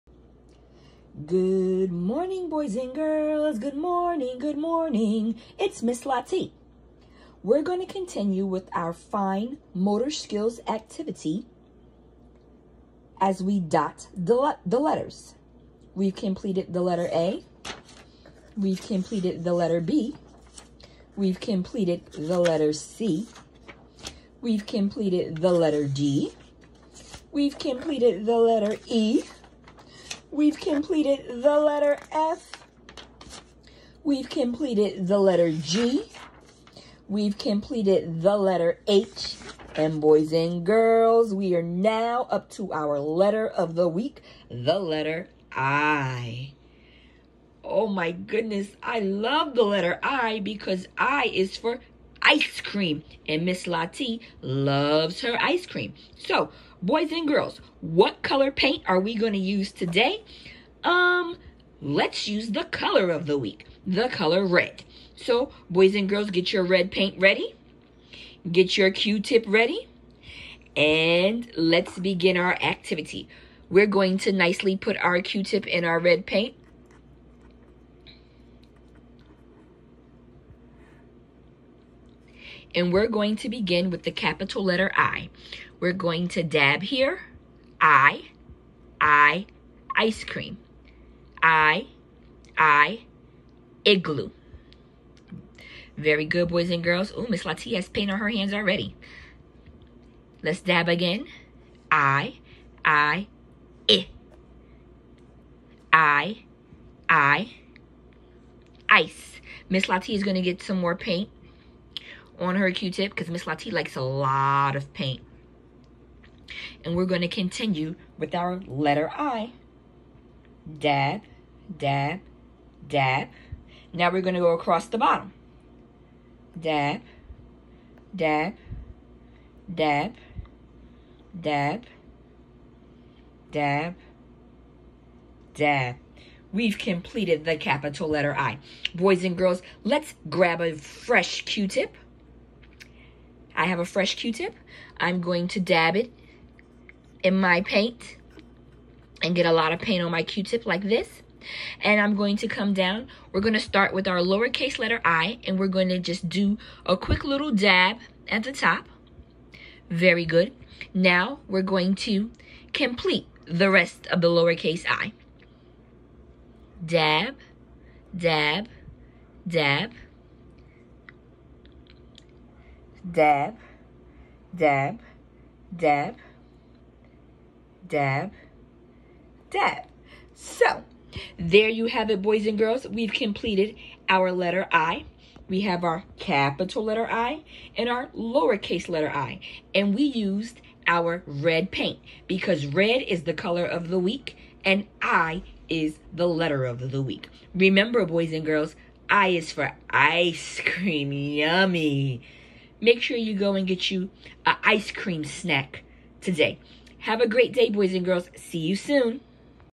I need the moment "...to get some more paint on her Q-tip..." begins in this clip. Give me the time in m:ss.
1:50.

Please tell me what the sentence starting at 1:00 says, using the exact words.
Um, let's use the color of the week, the color red.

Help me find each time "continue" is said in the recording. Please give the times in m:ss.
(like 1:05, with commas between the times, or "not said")
0:07, 1:57.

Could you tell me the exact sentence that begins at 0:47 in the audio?
Oh my goodness, I love the letter I because I is for ice cream.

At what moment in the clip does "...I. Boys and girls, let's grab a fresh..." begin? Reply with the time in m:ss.
2:18.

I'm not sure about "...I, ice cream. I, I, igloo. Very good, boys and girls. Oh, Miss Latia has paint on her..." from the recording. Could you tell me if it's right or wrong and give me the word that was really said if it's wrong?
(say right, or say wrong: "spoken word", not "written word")
right.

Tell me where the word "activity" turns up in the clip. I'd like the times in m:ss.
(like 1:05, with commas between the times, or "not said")
0:10, 1:12.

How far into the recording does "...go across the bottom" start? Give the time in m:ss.
2:04.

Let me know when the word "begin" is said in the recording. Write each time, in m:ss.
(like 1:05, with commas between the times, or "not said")
1:11, 1:23.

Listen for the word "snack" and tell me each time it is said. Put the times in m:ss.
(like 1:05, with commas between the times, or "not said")
3:25.